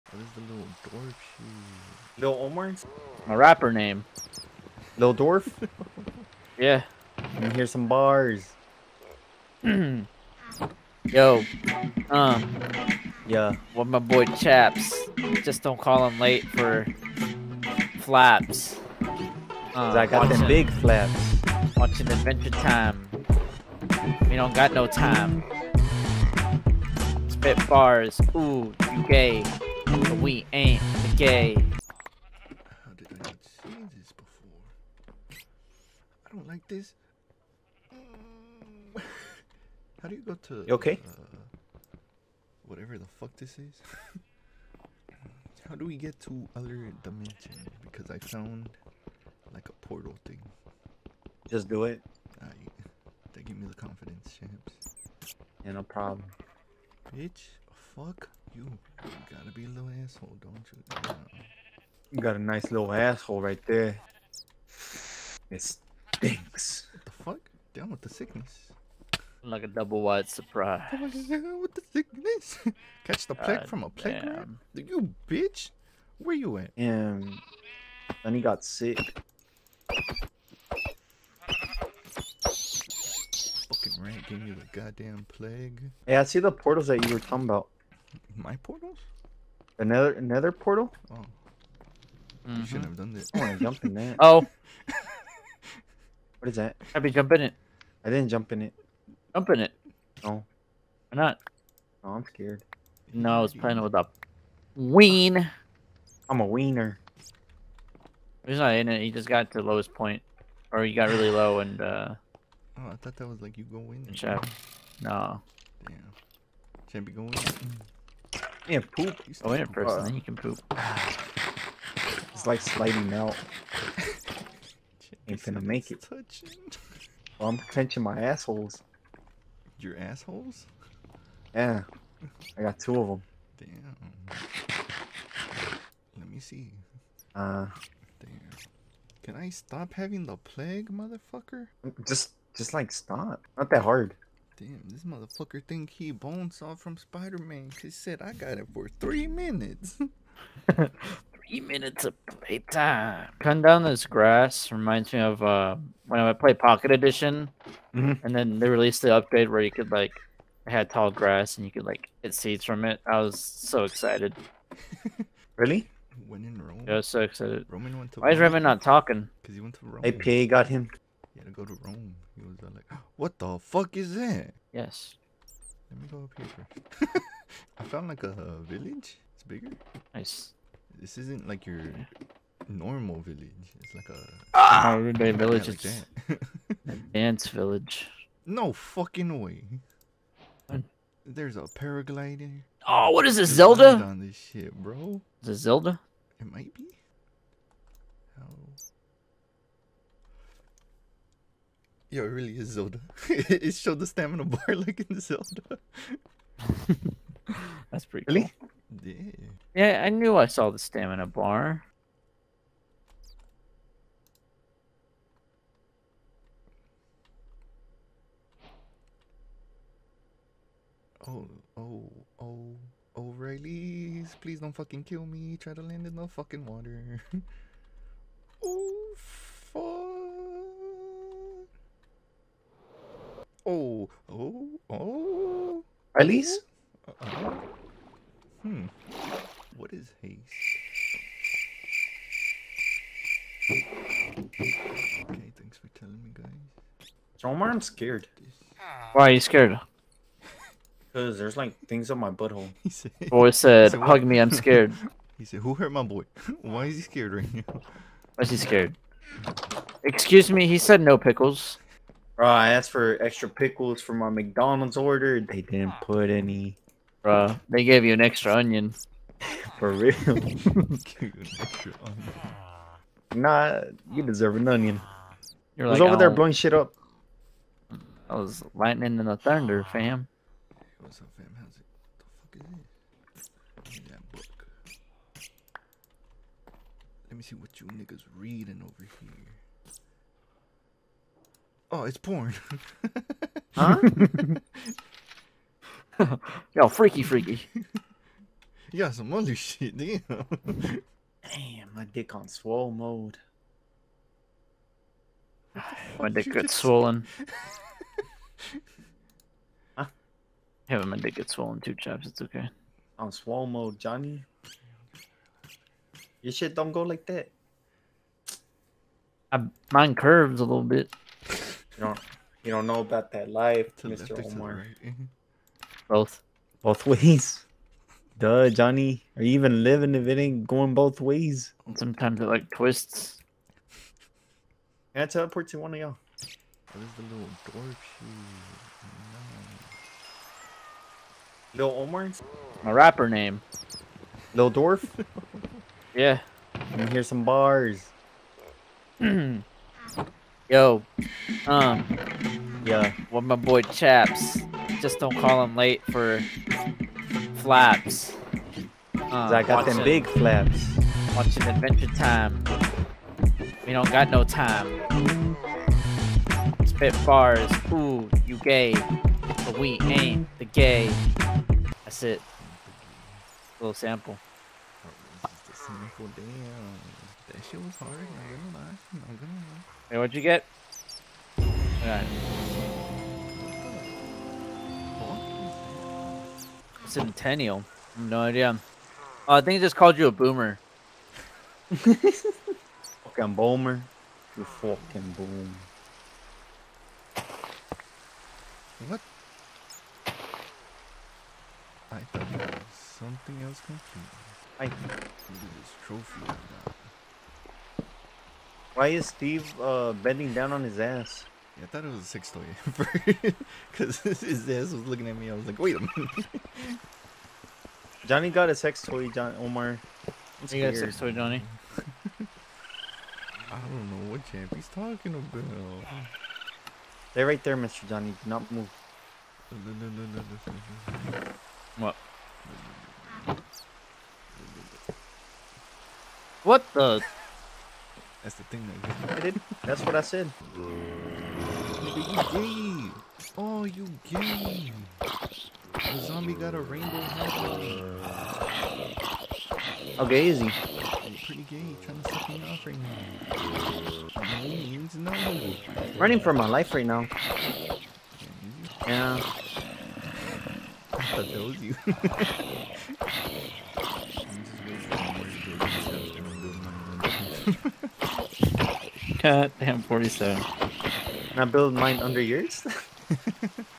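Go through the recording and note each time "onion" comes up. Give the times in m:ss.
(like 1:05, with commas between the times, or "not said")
4:28, 4:34.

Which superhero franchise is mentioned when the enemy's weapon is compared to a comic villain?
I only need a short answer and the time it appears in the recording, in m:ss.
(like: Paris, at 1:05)
Spider-Man, at 2:26.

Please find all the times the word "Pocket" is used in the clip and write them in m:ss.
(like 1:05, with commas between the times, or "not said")
2:36.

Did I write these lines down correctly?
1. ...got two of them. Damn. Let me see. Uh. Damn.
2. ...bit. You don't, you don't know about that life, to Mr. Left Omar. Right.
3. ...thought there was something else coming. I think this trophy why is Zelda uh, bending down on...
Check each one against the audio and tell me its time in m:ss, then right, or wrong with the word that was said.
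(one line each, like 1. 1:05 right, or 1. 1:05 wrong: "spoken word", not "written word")
1. 2:12 right
2. 5:20 right
3. 6:42 wrong: "Steve", not "Zelda".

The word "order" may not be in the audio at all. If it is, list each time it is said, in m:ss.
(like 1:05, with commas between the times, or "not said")
4:24.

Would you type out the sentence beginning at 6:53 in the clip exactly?
Because his ass was looking at me.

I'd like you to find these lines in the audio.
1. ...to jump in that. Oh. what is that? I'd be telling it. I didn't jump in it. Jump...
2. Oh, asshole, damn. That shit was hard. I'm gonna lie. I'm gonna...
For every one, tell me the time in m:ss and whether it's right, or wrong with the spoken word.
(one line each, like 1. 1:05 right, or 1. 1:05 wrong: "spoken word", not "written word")
1. 1:33 wrong: "jumping", not "telling"
2. 6:15 wrong: "sample", not "asshole".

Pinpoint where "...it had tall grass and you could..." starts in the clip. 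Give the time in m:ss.
2:40.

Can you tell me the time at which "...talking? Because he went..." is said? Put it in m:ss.
2:48.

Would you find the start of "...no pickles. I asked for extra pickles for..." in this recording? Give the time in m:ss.
4:21.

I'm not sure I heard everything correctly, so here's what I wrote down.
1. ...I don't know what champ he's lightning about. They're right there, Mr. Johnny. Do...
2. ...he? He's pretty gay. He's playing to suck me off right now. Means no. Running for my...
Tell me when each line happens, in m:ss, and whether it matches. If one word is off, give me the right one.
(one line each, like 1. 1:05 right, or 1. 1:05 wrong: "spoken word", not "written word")
1. 7:03 wrong: "talking", not "lightning"
2. 7:30 wrong: "trying", not "playing".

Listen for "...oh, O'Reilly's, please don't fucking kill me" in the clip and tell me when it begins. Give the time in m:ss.
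3:42.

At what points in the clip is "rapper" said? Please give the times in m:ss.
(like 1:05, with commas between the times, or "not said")
0:03, 5:42.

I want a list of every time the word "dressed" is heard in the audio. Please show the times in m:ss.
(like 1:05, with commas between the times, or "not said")
not said.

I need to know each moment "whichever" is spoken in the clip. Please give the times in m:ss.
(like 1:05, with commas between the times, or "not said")
not said.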